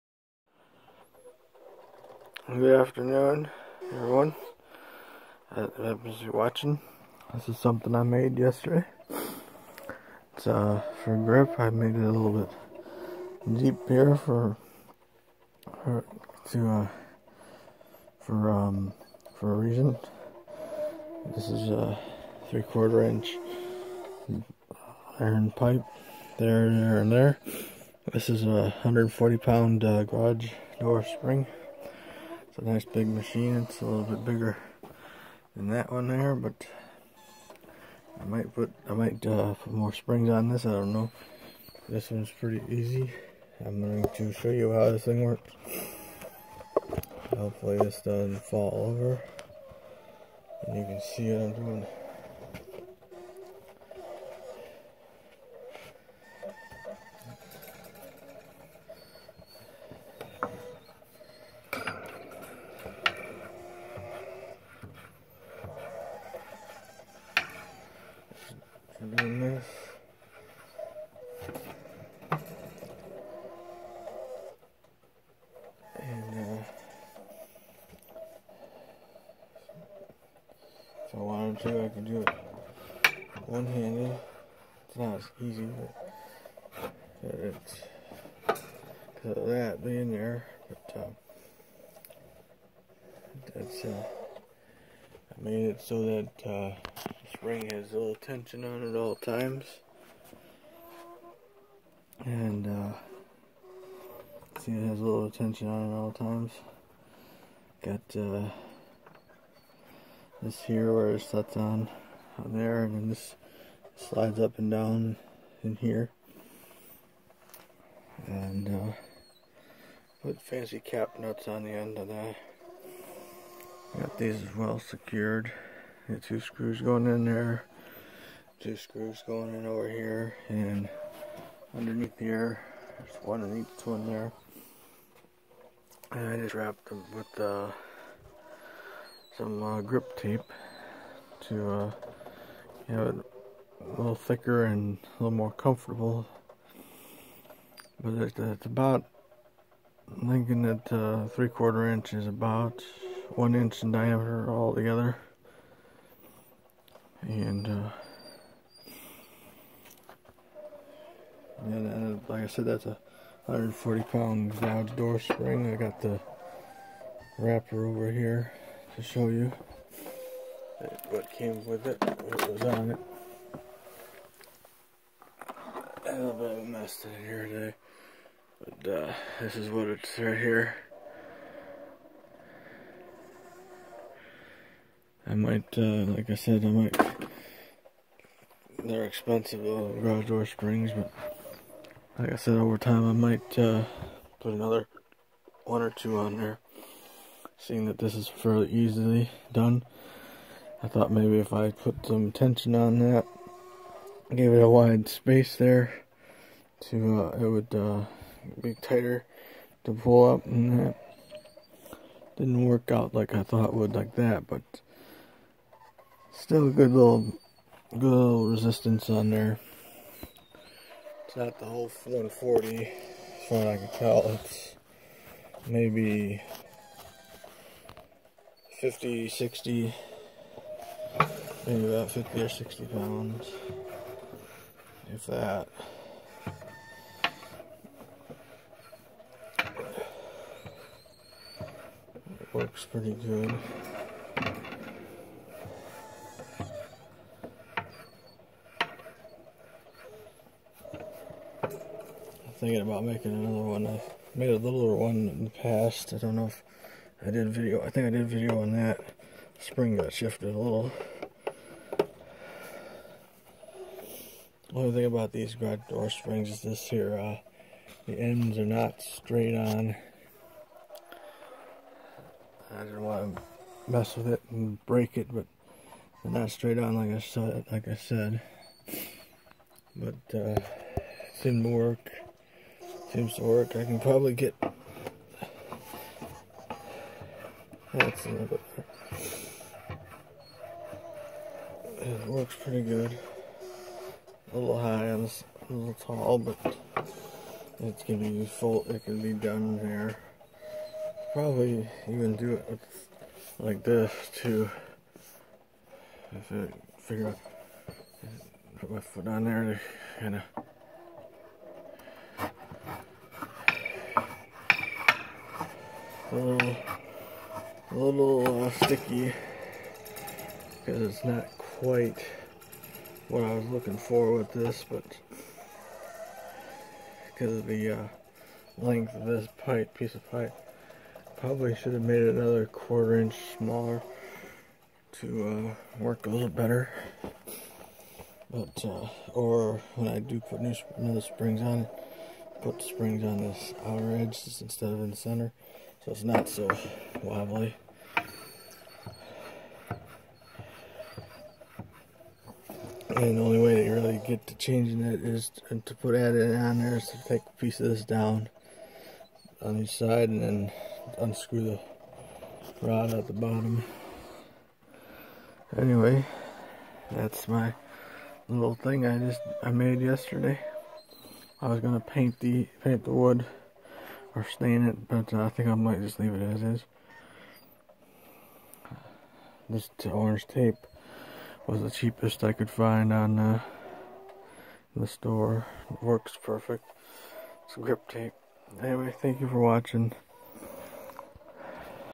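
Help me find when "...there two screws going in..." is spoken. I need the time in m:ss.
2:07.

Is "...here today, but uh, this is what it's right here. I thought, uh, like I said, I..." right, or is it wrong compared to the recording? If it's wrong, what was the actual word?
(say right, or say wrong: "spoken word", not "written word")
wrong: "might", not "thought".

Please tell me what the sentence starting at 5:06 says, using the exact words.
If I figure out, put my foot on there to kind of.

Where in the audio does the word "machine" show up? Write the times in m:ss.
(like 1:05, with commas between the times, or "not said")
0:33.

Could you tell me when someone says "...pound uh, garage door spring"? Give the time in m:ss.
0:29.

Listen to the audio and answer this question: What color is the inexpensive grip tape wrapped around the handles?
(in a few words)
Orange.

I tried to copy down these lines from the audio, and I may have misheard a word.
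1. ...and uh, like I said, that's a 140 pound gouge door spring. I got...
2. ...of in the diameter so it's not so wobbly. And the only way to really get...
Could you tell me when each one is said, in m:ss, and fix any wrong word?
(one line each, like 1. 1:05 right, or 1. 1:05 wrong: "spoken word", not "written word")
1. 2:41 right
2. 5:44 wrong: "center", not "diameter".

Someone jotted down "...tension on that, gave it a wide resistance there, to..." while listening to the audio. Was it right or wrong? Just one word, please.
wrong.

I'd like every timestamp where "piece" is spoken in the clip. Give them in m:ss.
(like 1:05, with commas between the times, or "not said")
5:29, 5:57.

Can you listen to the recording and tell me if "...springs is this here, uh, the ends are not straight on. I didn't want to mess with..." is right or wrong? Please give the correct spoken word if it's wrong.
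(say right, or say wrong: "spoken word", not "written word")
right.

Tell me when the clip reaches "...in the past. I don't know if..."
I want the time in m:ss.
4:15.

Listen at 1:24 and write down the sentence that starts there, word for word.
It's not as easy, but it's because of that being there.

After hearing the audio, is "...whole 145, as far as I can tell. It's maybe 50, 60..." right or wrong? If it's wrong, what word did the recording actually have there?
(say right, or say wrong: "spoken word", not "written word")
wrong: "140", not "145".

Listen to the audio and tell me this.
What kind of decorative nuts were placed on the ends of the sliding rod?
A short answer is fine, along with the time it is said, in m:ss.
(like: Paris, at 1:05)
Cap nuts, at 2:00.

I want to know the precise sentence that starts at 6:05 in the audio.
Anyway, that's my little thing I just I made yesterday.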